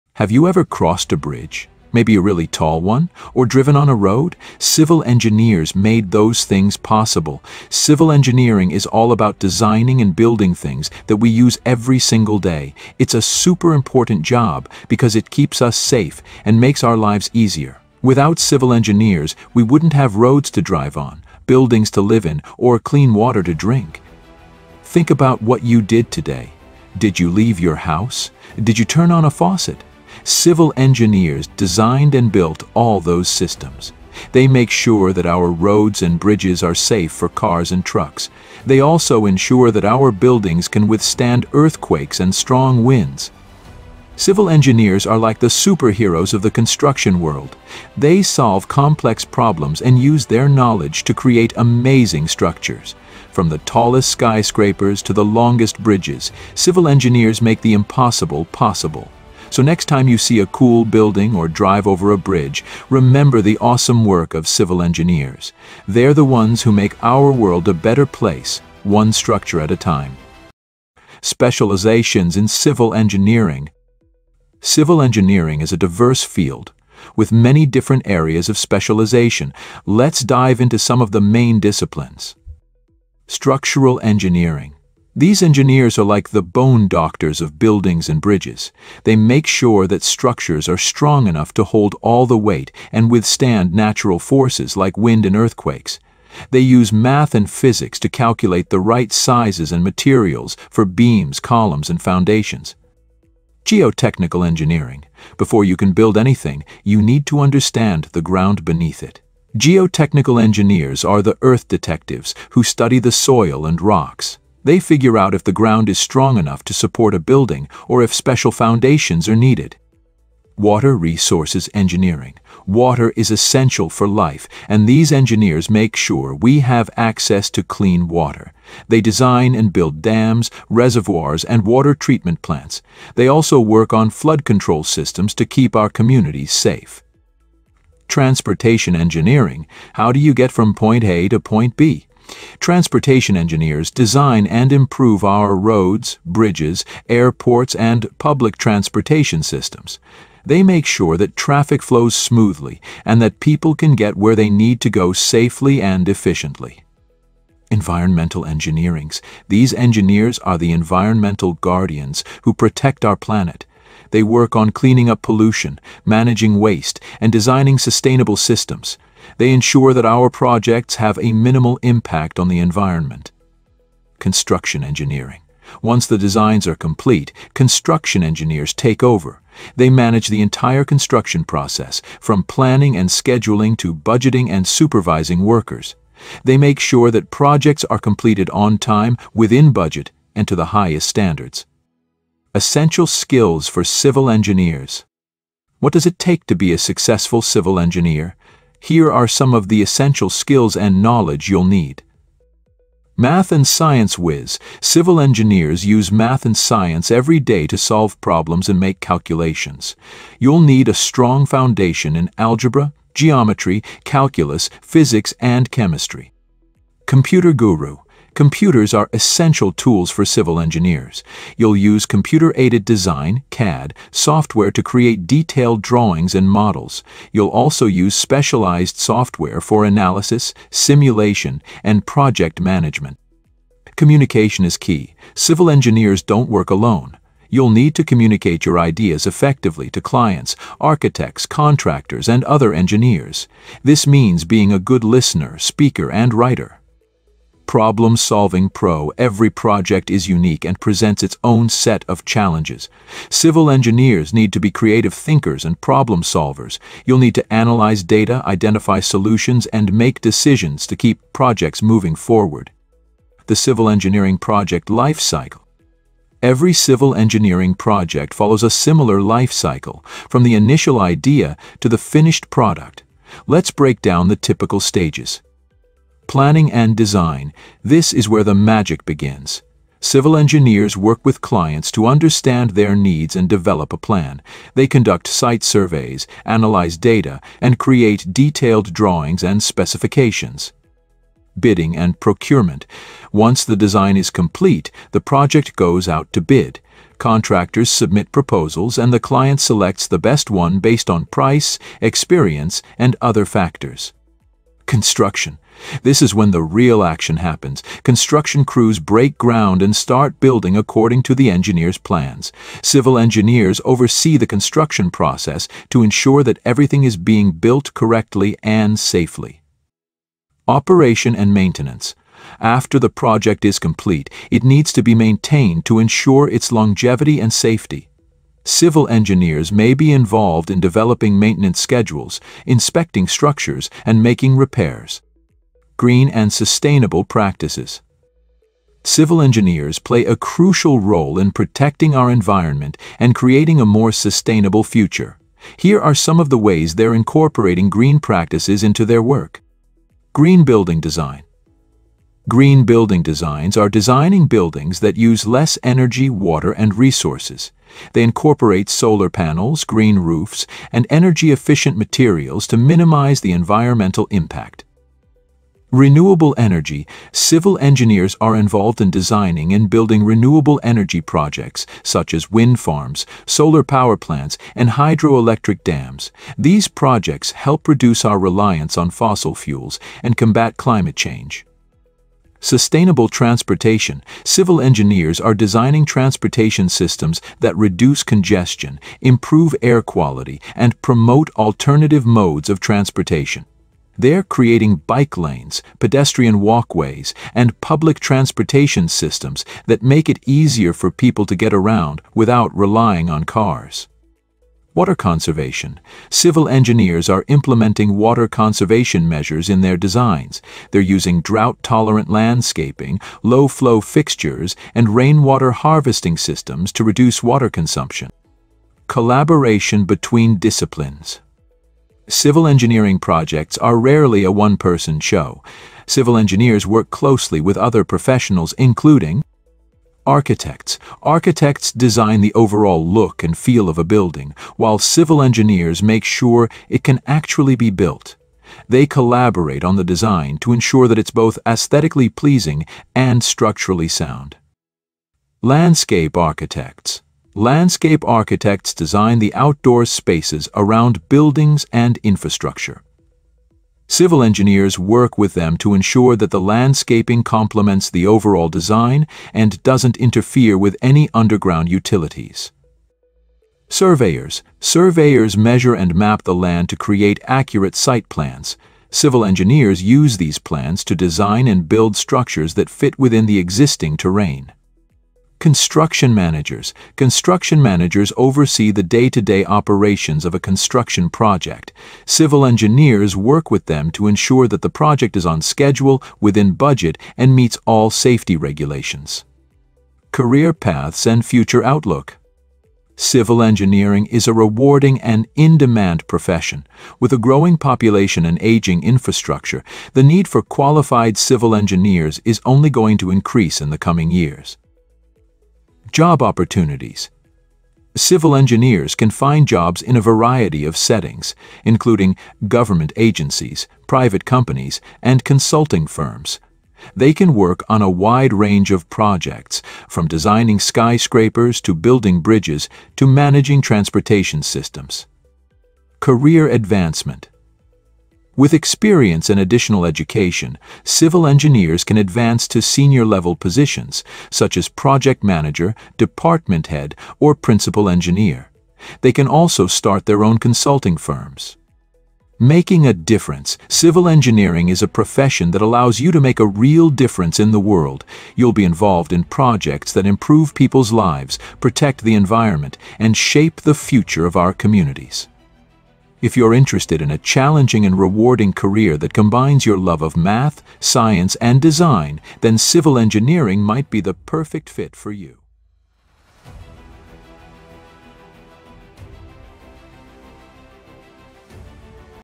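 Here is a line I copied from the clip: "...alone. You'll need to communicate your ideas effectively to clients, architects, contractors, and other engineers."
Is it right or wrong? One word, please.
right.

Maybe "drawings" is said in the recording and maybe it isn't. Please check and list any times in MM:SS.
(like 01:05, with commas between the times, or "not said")
03:45, 04:48.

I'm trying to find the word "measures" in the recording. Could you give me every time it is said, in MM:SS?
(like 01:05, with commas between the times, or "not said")
06:49, 07:45.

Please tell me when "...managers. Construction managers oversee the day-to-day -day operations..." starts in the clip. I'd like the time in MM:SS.
07:56.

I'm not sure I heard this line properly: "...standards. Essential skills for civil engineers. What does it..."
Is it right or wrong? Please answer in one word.
right.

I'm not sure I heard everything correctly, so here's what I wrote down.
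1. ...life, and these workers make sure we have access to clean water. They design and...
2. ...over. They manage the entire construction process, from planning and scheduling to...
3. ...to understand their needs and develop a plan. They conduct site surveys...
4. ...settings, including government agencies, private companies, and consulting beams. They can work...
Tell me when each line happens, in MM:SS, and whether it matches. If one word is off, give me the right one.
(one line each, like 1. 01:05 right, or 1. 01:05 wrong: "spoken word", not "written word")
1. 02:04 wrong: "engineers", not "workers"
2. 02:59 right
3. 04:41 right
4. 08:30 wrong: "firms", not "beams".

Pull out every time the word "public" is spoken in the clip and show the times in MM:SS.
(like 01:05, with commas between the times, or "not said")
02:28, 06:37.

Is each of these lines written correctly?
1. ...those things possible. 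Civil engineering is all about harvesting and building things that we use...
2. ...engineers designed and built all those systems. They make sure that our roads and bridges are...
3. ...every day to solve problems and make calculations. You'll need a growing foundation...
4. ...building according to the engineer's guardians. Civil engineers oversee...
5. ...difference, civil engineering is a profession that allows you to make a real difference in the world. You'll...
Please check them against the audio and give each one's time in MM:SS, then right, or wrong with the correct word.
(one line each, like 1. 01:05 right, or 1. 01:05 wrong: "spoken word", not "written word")
1. 00:06 wrong: "designing", not "harvesting"
2. 00:30 right
3. 03:27 wrong: "strong", not "growing"
4. 05:10 wrong: "plans", not "guardians"
5. 09:03 right.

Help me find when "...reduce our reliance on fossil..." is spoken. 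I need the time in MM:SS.
06:17.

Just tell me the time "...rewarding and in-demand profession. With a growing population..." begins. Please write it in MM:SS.
08:14.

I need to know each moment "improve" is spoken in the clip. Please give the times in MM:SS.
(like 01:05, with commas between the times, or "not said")
02:24, 06:29, 09:10.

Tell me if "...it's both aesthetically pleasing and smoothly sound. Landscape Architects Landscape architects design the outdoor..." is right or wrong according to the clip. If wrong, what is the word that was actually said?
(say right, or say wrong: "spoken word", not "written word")
wrong: "structurally", not "smoothly".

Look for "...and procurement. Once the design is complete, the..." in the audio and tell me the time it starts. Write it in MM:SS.
04:51.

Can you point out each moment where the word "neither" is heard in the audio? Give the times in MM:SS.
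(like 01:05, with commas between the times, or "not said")
not said.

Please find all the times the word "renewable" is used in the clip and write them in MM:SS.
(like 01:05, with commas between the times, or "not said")
06:05, 06:10.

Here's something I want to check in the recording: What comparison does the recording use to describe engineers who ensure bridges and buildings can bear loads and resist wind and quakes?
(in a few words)
bone doctors.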